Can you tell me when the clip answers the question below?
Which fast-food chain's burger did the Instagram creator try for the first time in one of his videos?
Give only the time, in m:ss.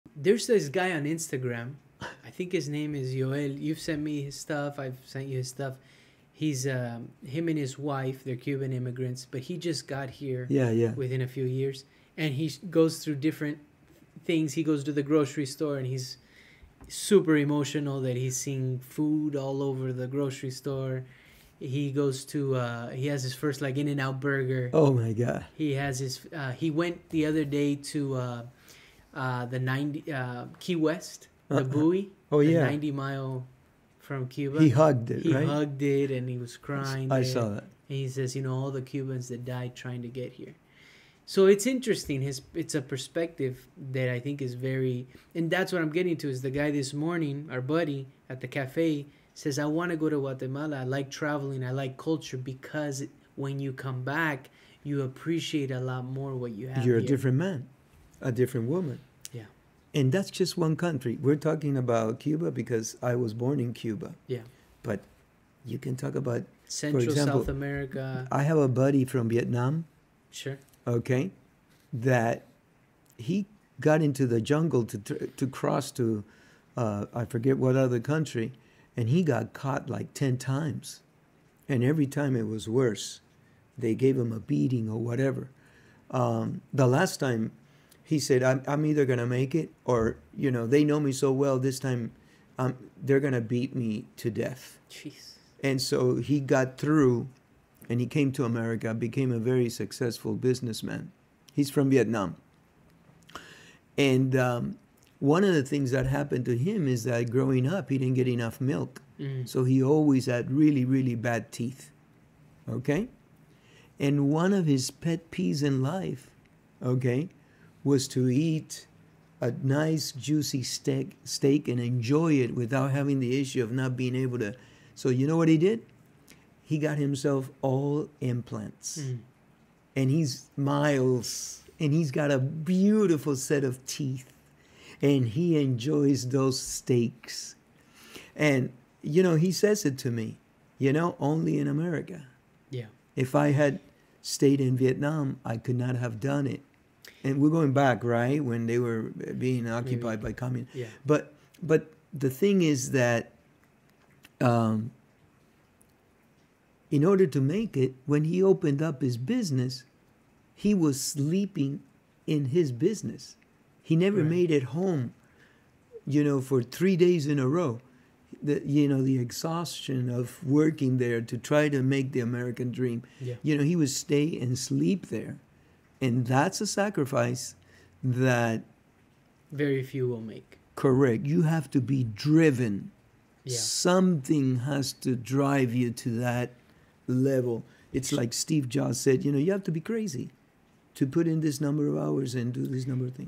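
0:23.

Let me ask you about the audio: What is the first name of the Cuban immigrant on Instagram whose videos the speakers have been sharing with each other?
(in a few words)
Yoel.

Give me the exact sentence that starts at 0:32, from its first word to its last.
Oh yeah, 90 mile from Cuba.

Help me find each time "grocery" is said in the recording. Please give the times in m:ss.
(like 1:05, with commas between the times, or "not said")
0:15, 0:20.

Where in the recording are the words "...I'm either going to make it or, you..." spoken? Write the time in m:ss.
1:28.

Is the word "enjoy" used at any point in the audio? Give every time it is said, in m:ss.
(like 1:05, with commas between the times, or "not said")
2:01, 2:15.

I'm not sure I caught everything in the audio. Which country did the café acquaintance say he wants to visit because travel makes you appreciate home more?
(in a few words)
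Guatemala.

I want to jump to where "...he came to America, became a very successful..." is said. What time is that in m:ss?
1:38.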